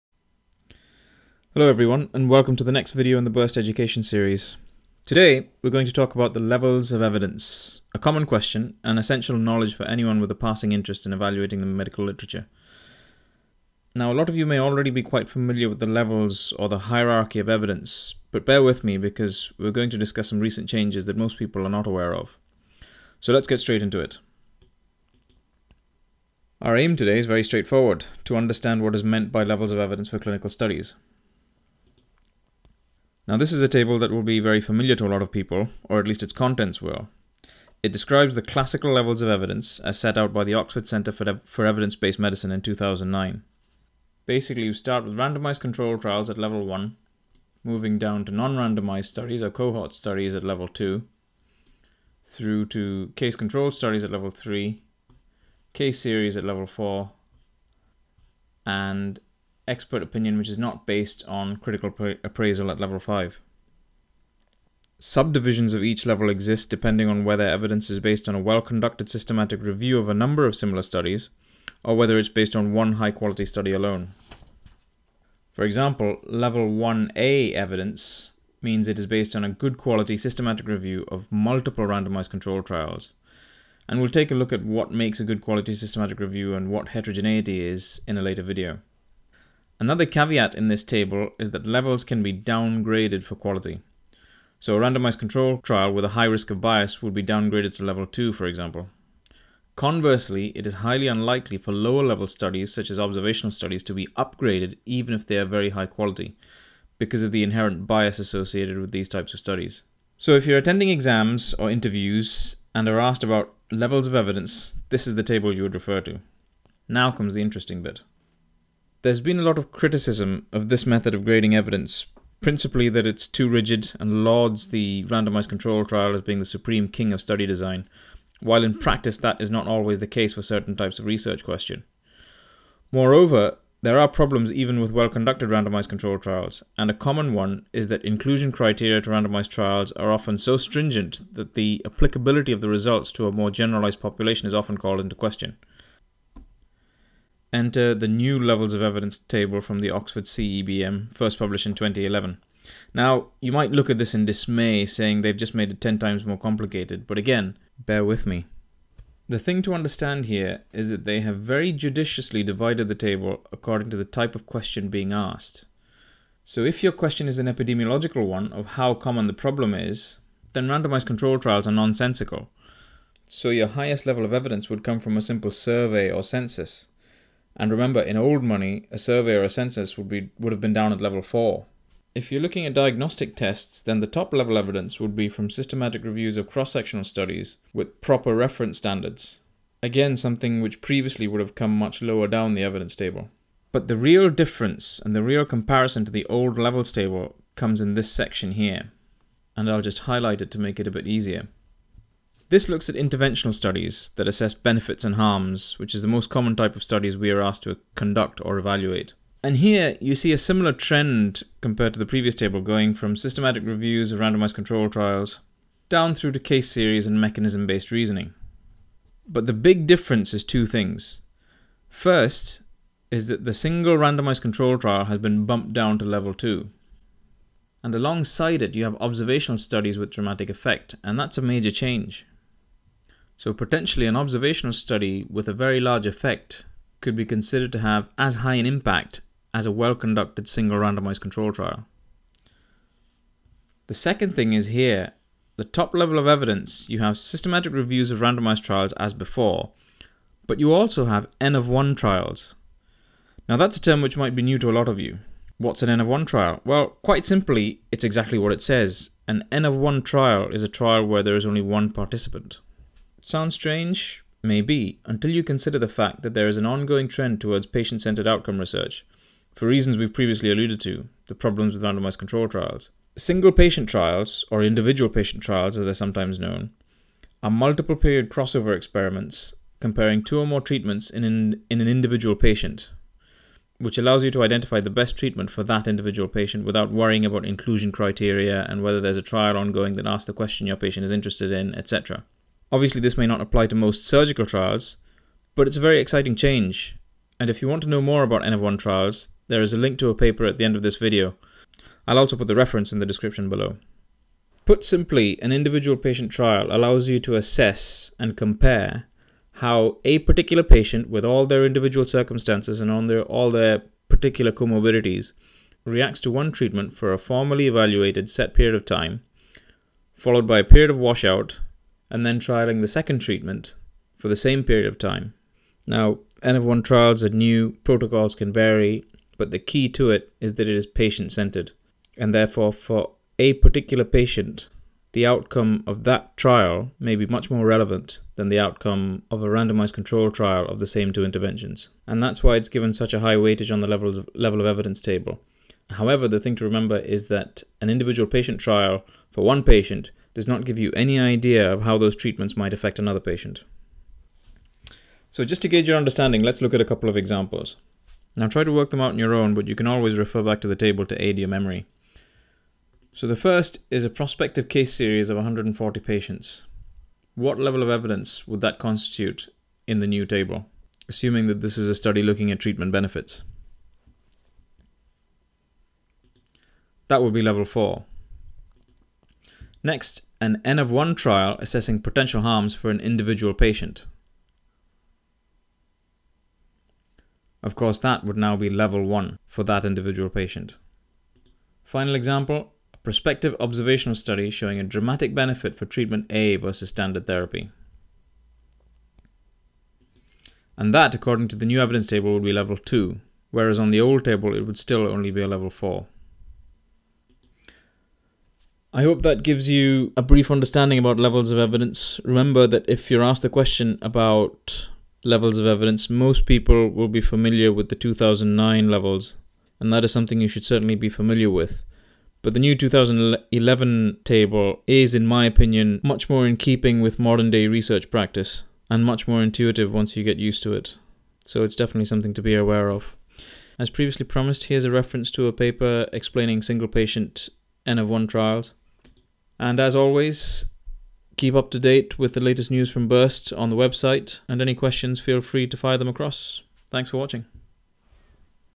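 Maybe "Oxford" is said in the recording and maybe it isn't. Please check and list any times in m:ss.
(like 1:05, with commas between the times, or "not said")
0:40, 2:29.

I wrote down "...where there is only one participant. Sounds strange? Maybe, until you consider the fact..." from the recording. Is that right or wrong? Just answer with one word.
right.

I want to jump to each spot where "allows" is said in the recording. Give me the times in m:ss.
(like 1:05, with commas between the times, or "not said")
4:43, 5:06.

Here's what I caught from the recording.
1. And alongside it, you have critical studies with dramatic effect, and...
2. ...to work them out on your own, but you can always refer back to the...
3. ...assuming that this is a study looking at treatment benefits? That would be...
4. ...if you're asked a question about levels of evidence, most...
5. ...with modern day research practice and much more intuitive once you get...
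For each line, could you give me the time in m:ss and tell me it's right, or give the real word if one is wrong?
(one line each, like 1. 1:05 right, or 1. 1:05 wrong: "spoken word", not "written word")
1. 3:47 wrong: "observational", not "critical"
2. 5:58 right
3. 6:11 right
4. 6:52 right
5. 7:06 right.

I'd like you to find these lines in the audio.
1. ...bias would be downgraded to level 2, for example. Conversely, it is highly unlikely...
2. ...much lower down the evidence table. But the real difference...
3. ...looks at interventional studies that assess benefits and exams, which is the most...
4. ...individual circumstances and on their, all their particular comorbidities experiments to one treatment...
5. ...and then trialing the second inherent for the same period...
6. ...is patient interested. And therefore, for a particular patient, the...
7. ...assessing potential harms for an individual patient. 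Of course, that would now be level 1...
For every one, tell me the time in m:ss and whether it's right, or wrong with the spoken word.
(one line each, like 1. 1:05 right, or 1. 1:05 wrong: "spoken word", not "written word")
1. 1:36 right
2. 3:11 right
3. 3:22 wrong: "harms", not "exams"
4. 5:11 wrong: "reacts", not "experiments"
5. 5:22 wrong: "treatment", not "inherent"
6. 5:30 wrong: "centered", not "interested"
7. 6:21 right.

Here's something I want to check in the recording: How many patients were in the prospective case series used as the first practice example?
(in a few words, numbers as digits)
140.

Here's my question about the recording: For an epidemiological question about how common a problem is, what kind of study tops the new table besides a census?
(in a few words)
A simple survey.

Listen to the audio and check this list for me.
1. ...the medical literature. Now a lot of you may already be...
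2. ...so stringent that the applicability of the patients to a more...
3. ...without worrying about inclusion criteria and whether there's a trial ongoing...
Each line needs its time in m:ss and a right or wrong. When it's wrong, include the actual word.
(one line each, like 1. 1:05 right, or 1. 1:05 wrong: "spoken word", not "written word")
1. 0:11 right
2. 2:20 wrong: "results", not "patients"
3. 4:46 right.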